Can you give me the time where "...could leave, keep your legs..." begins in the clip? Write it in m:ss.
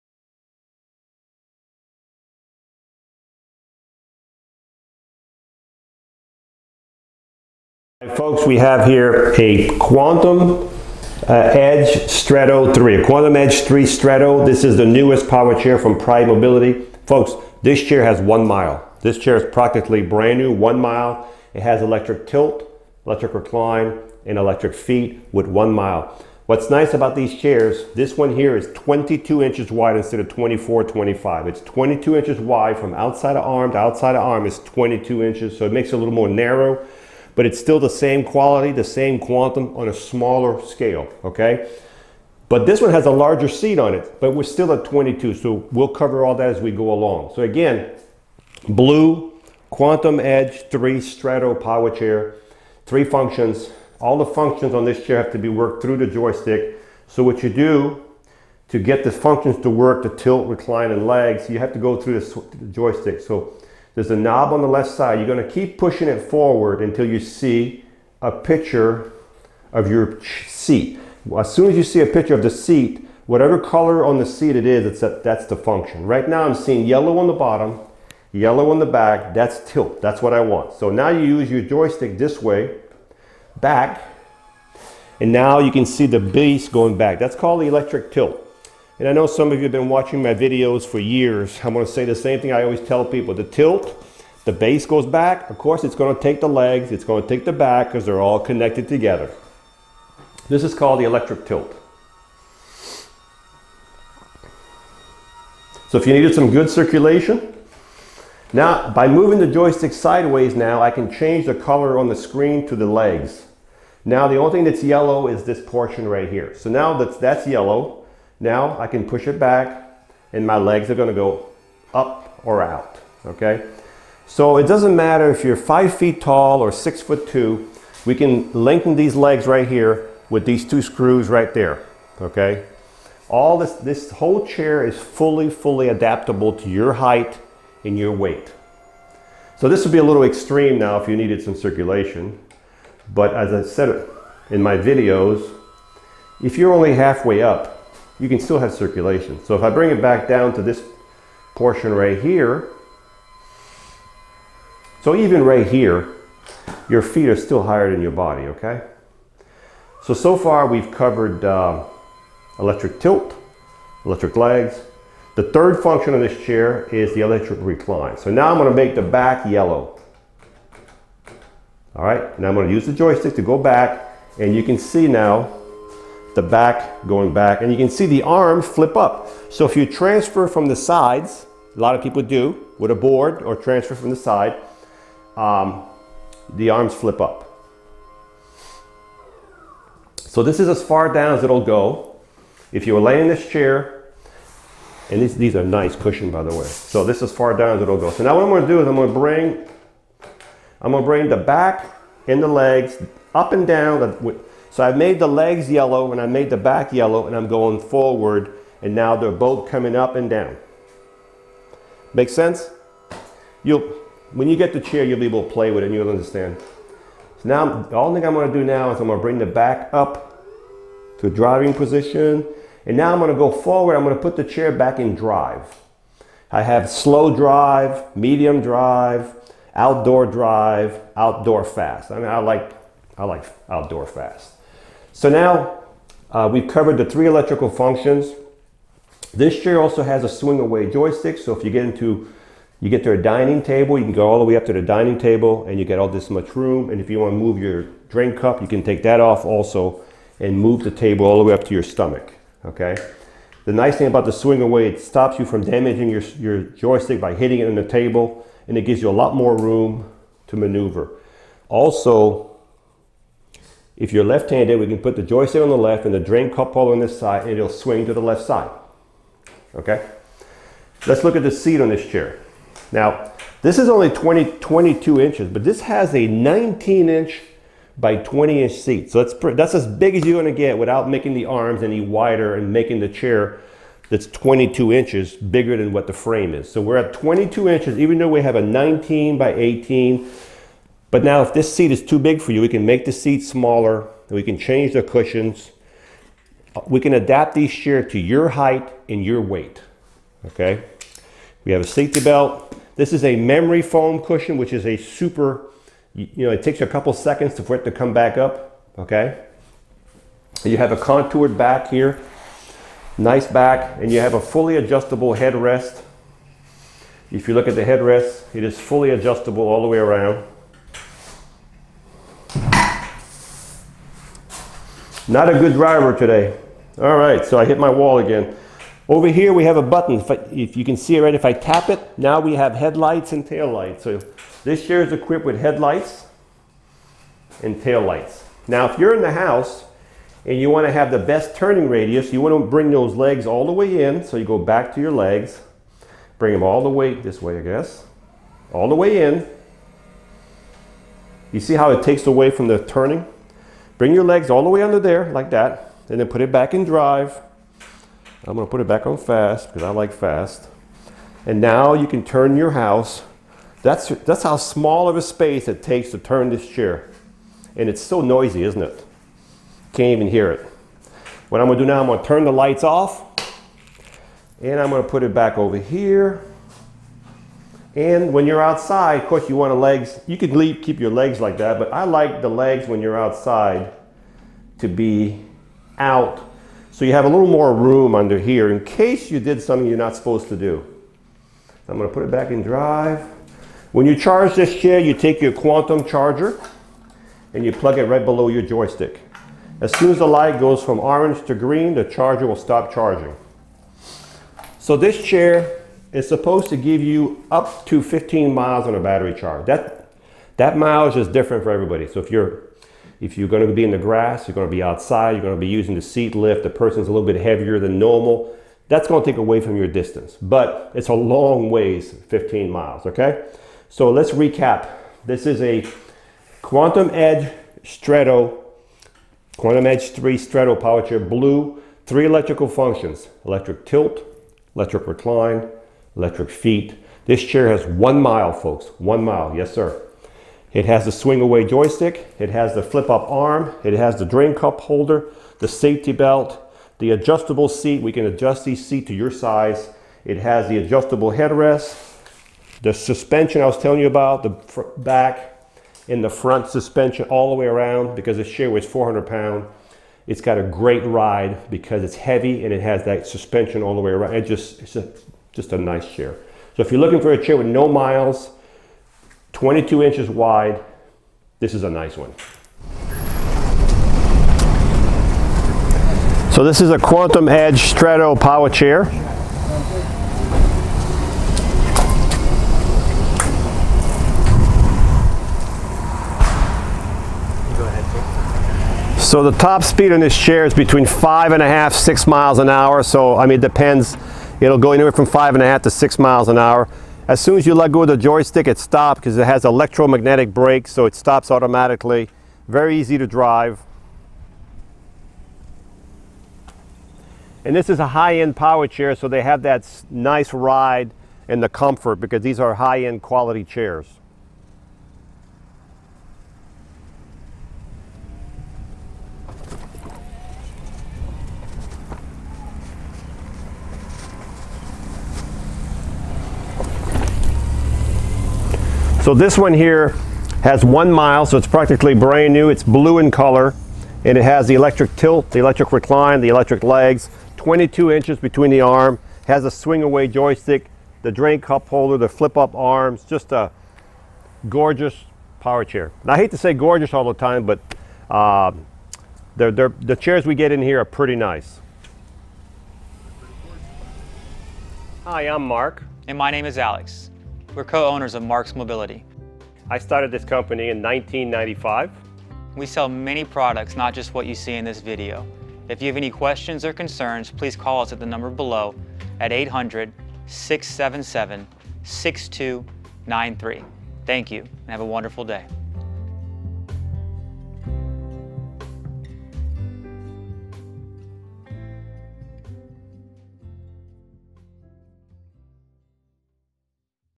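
6:20.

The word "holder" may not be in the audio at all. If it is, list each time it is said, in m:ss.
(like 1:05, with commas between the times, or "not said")
4:26, 7:24, 9:01.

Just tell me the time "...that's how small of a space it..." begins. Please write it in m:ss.
6:04.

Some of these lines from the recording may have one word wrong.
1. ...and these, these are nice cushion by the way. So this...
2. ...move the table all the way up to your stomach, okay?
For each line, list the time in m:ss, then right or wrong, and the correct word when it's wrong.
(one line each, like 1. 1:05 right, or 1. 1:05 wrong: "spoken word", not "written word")
1. 3:15 right
2. 4:10 right.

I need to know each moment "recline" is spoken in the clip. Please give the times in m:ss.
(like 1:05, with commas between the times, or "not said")
0:23, 1:00, 2:47, 7:15, 8:55.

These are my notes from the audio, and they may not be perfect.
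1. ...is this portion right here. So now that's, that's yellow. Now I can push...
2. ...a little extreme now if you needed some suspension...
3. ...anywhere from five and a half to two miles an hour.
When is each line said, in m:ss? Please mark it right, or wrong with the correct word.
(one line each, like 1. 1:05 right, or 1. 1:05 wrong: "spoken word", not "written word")
1. 1:55 right
2. 2:19 wrong: "circulation", not "suspension"
3. 8:14 wrong: "six", not "two".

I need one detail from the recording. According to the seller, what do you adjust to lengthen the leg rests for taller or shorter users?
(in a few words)
Two screws.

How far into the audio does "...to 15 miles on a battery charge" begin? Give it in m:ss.
6:47.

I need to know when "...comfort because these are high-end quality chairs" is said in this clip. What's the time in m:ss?
8:31.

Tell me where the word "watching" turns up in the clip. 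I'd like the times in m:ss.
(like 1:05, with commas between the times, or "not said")
1:29.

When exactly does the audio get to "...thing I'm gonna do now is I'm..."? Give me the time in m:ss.
3:38.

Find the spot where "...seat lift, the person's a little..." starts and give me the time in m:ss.
6:56.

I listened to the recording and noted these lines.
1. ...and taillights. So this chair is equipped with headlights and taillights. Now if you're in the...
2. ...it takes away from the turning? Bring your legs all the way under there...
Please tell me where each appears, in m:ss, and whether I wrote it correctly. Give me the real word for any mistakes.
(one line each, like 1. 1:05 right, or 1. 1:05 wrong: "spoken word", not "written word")
1. 5:33 right
2. 5:51 right.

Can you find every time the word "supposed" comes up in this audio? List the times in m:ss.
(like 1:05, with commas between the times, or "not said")
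6:30, 6:46.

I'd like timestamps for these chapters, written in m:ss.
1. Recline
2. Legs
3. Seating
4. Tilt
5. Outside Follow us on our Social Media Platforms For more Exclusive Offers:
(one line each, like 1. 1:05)
1. 2:45
2. 1:45
3. 3:42
4. 1:15
5. 7:53.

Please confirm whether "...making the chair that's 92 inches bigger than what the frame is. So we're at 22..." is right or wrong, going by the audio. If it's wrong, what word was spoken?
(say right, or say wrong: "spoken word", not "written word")
wrong: "22", not "92".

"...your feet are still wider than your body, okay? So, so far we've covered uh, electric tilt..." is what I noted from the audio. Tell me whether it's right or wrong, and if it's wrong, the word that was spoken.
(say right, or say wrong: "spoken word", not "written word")
wrong: "higher", not "wider".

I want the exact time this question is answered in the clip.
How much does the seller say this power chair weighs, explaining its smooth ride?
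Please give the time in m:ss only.
7:38.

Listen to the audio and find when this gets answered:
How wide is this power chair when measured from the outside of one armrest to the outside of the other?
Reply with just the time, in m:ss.
0:31.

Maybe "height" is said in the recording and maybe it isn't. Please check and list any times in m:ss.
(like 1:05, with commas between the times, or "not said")
2:16, 4:58.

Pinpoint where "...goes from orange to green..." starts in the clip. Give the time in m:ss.
6:40.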